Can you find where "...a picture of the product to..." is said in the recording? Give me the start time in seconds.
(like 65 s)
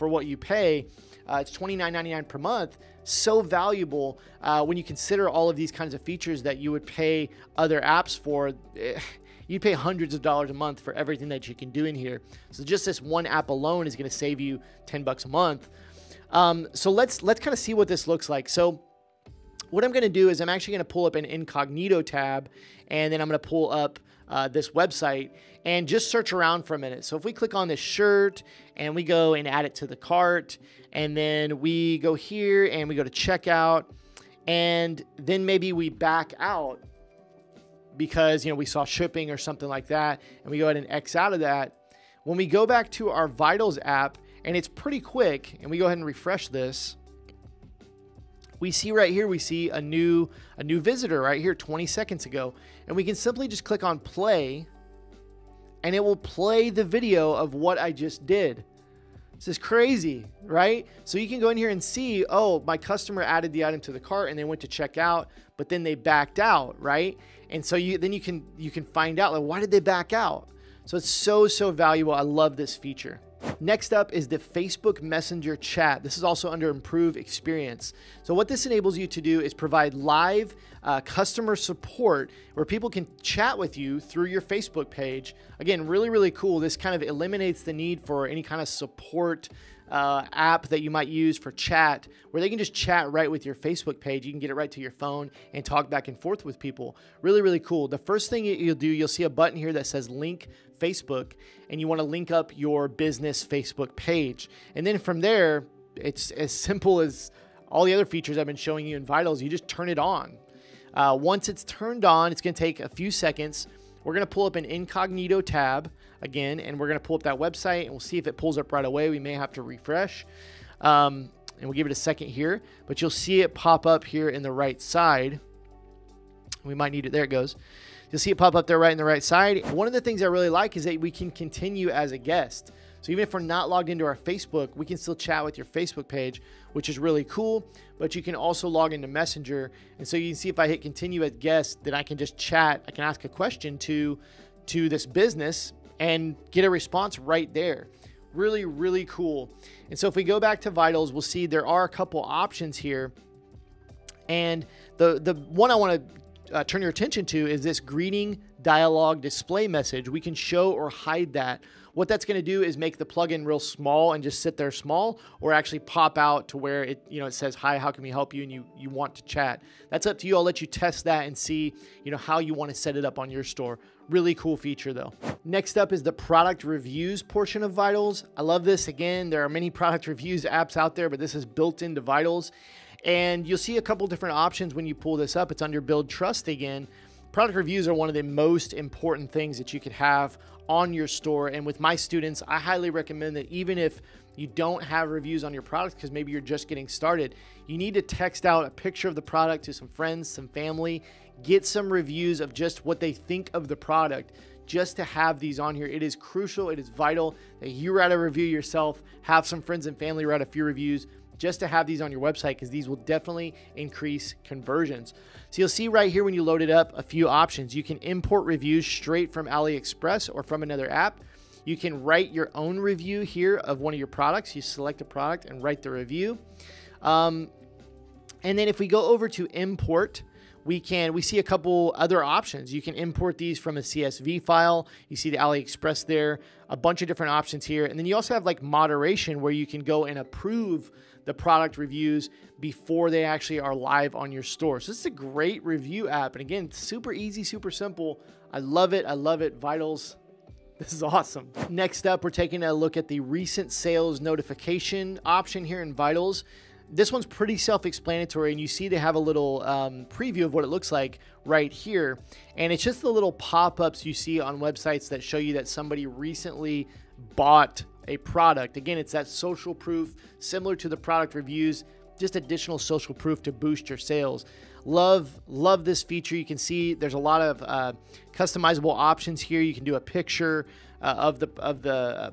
198 s.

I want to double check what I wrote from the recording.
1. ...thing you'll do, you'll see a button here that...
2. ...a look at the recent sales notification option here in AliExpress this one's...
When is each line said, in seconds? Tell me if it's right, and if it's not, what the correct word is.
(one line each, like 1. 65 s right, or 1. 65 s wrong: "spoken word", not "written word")
1. 98 s right
2. 252 s wrong: "Vitals", not "AliExpress".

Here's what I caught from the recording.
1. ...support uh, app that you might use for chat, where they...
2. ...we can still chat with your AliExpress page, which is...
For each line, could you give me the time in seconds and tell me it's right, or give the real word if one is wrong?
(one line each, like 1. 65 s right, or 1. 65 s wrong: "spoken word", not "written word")
1. 88 s right
2. 134 s wrong: "Facebook", not "AliExpress".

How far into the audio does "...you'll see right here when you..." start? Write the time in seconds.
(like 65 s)
215 s.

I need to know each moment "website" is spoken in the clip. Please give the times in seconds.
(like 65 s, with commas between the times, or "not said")
24 s, 117 s, 212 s, 264 s.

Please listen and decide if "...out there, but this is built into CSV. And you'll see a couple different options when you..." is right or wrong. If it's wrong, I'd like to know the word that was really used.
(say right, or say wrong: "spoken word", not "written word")
wrong: "Vitals", not "CSV".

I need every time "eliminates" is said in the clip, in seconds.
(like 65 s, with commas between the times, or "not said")
87 s.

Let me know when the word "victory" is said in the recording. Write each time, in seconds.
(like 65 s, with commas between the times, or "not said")
not said.